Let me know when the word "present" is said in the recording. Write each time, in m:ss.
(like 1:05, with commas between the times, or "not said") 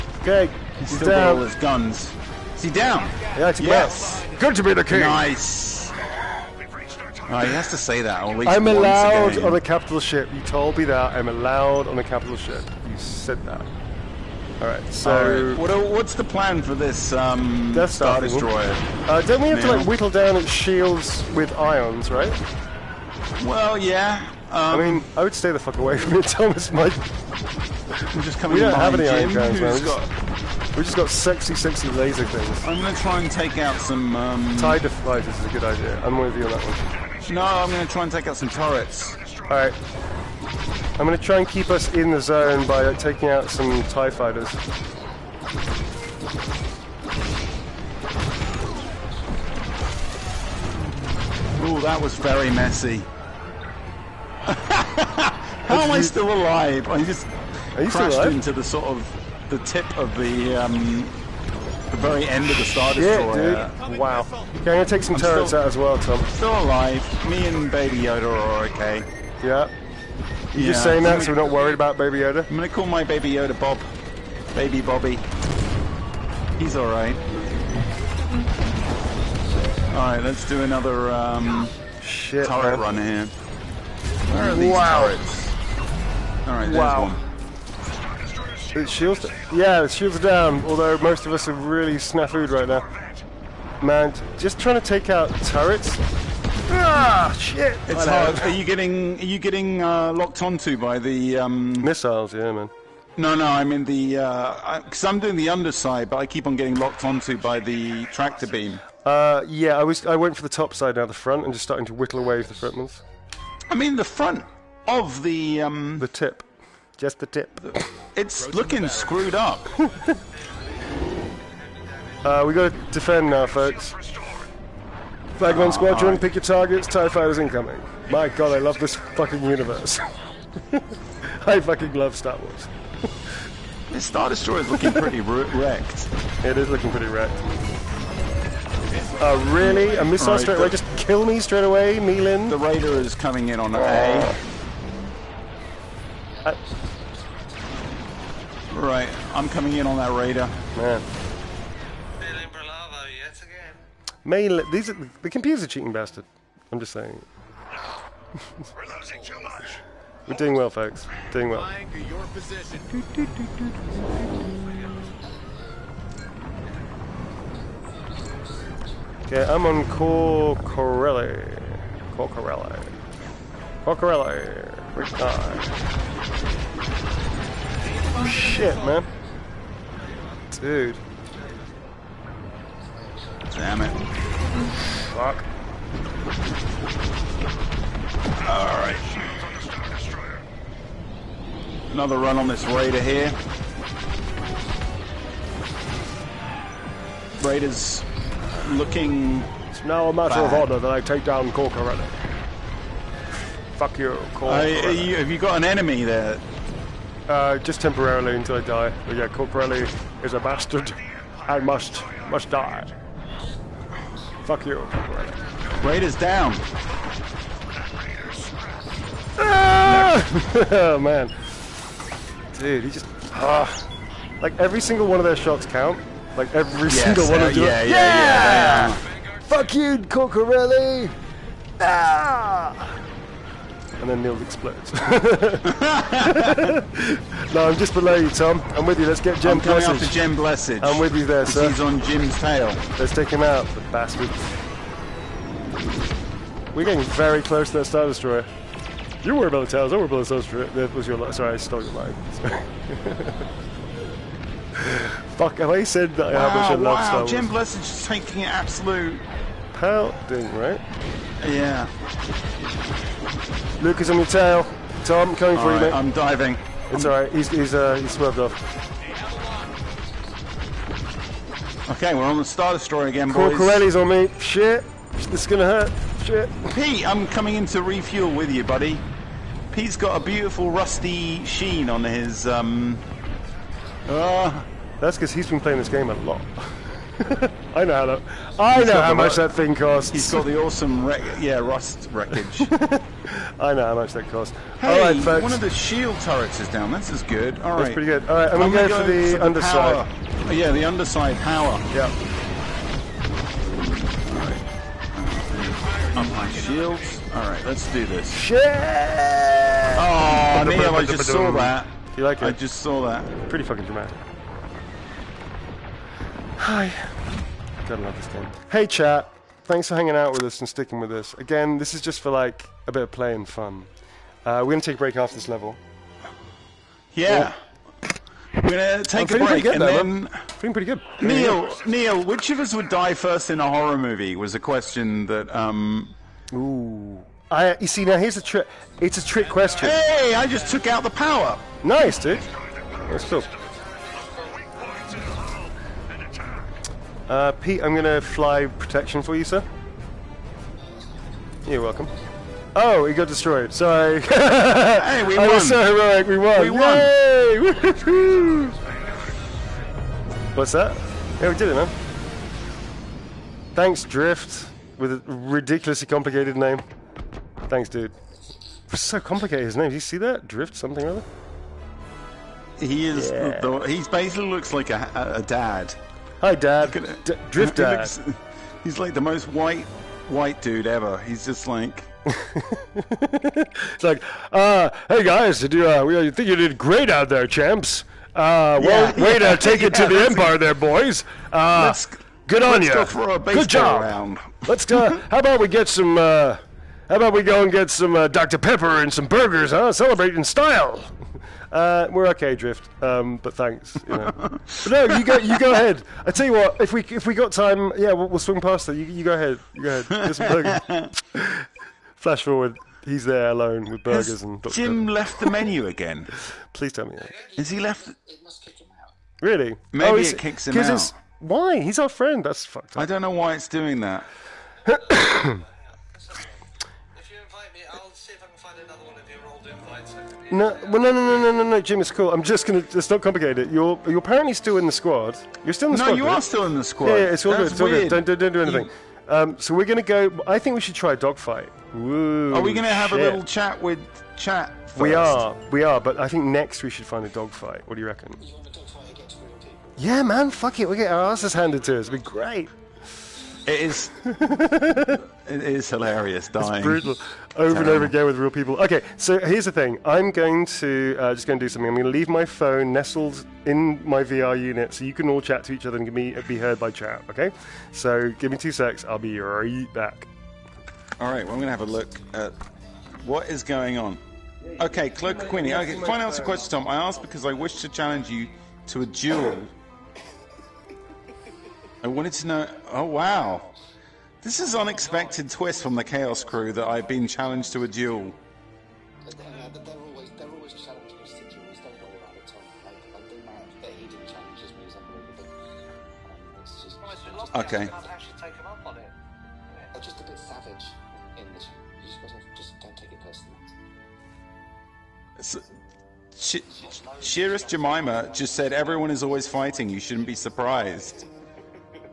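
not said.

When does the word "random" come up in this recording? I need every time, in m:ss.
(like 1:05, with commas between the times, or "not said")
not said.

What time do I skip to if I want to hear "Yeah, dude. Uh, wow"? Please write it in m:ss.
1:03.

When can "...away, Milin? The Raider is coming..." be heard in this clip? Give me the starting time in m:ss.
2:21.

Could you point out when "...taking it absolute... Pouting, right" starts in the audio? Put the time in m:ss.
4:18.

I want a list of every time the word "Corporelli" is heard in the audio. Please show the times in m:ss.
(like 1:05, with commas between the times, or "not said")
3:29, 3:34, 3:49.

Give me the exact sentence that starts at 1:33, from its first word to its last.
Man, just trying to take out turrets.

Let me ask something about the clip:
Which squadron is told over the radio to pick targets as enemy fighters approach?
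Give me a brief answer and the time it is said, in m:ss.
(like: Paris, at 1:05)
Flag 1 Squadron, at 2:05.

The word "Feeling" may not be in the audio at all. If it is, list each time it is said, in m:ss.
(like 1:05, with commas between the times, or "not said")
5:30.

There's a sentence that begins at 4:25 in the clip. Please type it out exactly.
Tom, coming for right, you, mate.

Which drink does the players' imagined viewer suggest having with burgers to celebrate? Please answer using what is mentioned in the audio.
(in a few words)
Dr Pepper.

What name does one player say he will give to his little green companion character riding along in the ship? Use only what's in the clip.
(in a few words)
Bob.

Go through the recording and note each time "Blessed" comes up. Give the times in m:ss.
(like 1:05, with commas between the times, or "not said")
4:00, 4:17.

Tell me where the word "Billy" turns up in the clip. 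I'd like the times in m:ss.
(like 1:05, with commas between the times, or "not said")
2:32.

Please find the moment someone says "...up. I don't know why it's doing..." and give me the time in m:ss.
7:02.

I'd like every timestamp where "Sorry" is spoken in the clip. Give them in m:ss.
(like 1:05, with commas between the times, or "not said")
4:11, 5:53.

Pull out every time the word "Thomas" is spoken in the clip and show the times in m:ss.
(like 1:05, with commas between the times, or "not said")
0:26.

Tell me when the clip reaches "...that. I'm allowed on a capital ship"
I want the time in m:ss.
0:10.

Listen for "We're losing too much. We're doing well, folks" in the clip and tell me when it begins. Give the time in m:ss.
2:37.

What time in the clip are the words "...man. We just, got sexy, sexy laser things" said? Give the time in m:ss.
0:29.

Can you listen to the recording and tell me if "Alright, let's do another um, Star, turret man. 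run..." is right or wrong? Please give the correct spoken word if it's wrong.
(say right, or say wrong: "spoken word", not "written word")
wrong: "Shit", not "Star".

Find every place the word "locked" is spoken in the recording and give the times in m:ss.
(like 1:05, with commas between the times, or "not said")
1:40, 1:46.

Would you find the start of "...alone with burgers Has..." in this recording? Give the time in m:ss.
6:53.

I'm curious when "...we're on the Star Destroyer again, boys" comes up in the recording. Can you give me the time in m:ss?
4:32.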